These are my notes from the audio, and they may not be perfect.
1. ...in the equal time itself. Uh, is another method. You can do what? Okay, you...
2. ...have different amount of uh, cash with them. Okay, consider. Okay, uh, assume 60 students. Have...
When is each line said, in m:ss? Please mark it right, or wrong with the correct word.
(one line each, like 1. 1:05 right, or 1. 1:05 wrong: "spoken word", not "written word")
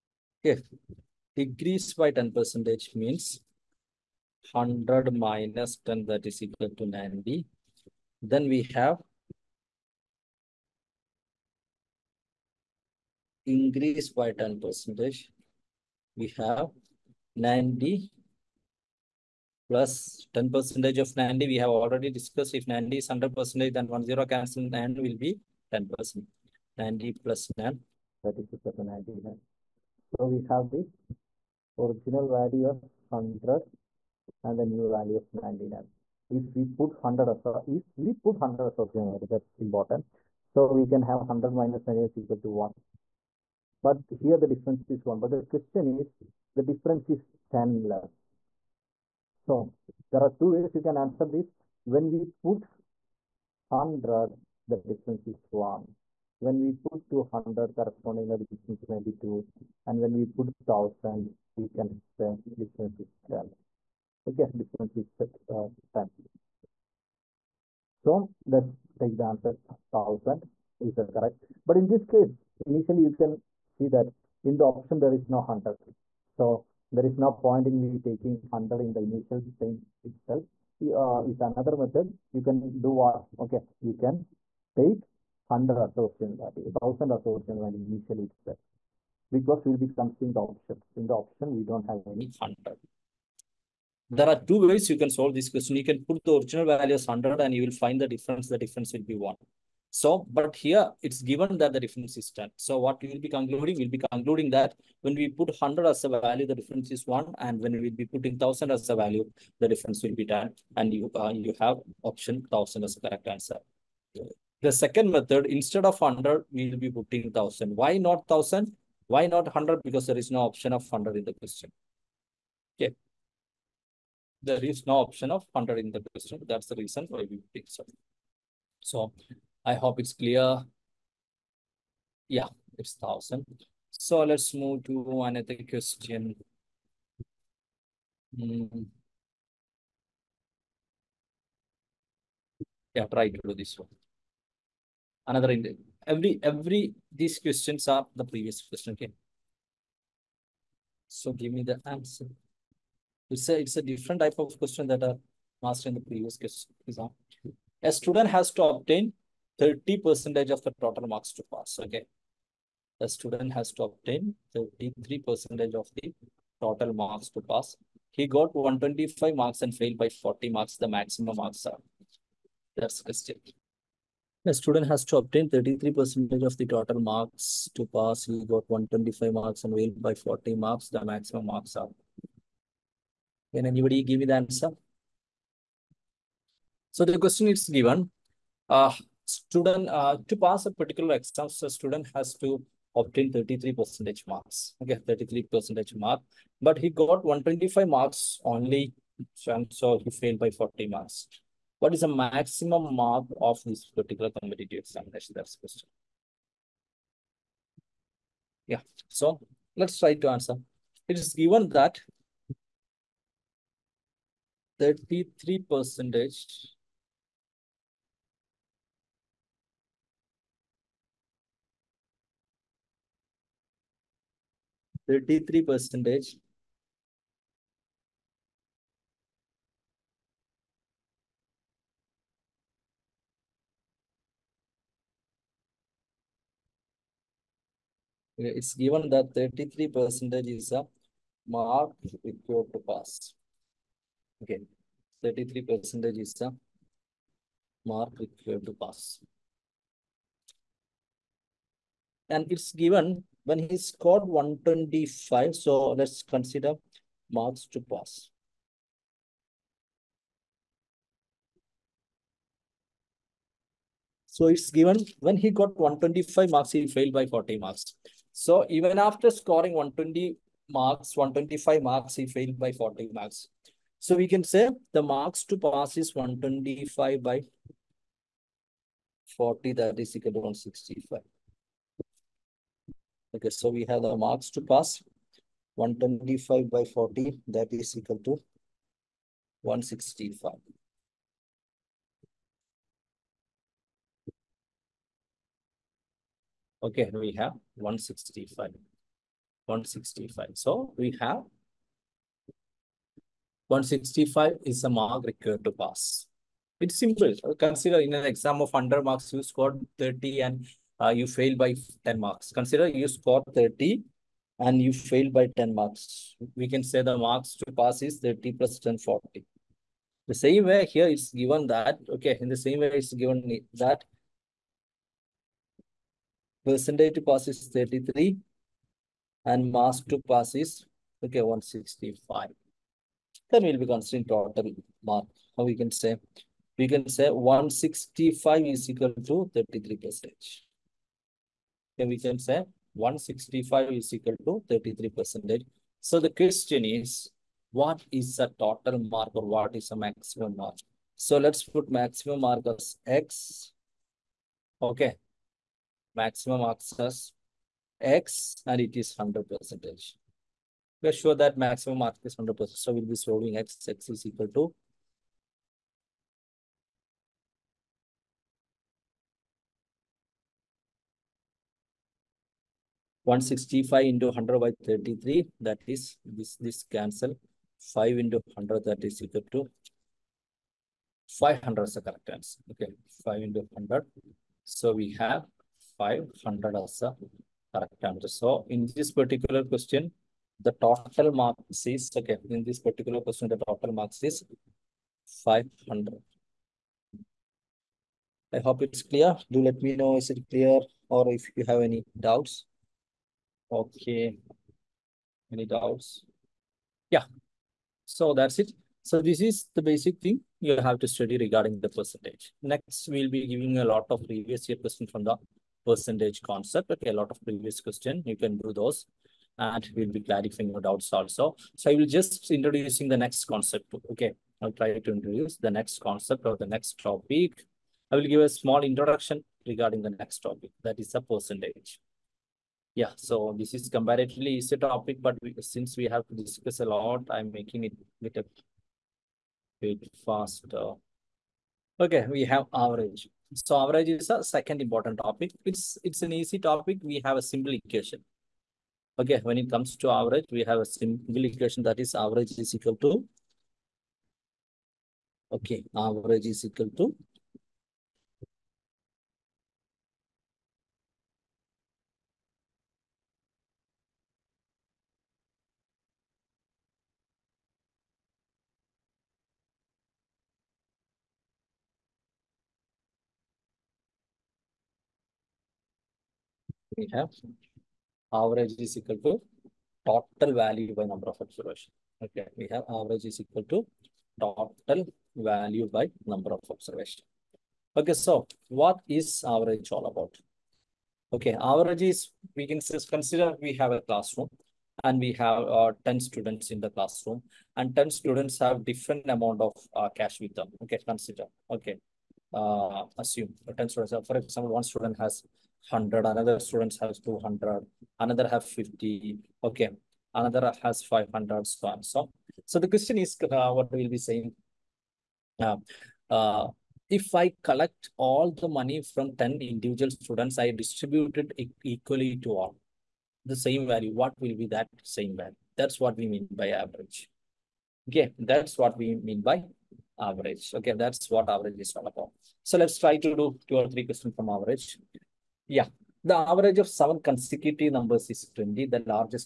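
1. 1:18 wrong: "initial", not "equal"
2. 8:18 wrong: "10", not "60".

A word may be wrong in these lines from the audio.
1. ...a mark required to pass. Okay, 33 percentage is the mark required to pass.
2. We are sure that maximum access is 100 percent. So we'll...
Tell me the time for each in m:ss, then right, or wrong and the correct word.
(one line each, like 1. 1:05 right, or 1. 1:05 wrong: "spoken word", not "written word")
1. 4:00 right
2. 6:01 right.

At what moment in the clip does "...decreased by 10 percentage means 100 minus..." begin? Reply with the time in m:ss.
0:01.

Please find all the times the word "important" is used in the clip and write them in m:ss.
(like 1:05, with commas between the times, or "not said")
0:39, 7:24.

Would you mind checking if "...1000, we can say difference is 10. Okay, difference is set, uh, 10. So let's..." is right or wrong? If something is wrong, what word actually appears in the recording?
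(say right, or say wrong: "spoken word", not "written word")
right.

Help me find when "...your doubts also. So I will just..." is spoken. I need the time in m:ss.
7:00.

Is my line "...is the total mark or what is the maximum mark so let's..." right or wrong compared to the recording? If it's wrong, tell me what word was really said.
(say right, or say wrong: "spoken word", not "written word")
right.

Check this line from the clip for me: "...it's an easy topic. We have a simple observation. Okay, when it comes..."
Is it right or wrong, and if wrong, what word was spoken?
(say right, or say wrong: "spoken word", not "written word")
wrong: "equation", not "observation".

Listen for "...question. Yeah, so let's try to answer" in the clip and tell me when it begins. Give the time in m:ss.
3:25.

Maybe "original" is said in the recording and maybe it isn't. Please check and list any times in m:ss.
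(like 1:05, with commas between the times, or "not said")
0:31, 0:38, 1:36.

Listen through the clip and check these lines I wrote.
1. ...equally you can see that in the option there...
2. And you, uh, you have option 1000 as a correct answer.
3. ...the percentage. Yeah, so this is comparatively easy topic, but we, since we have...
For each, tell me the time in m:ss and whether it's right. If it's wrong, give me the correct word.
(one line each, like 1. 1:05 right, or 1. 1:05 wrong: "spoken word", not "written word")
1. 1:12 wrong: "initially", not "equally"
2. 1:50 right
3. 7:11 right.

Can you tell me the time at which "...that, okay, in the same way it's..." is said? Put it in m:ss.
5:21.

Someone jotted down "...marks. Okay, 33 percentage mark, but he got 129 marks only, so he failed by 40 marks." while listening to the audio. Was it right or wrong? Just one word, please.
wrong.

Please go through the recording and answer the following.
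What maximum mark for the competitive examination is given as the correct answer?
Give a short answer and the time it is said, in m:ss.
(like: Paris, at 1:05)
500, at 6:18.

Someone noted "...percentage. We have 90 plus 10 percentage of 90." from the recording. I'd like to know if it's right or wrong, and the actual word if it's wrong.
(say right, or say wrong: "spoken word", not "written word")
right.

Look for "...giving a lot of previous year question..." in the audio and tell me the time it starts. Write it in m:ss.
6:53.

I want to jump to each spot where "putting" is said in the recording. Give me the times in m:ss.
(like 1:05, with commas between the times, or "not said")
1:48, 1:56, 2:07.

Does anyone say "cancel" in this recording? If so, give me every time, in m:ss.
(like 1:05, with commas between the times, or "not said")
0:24, 6:16.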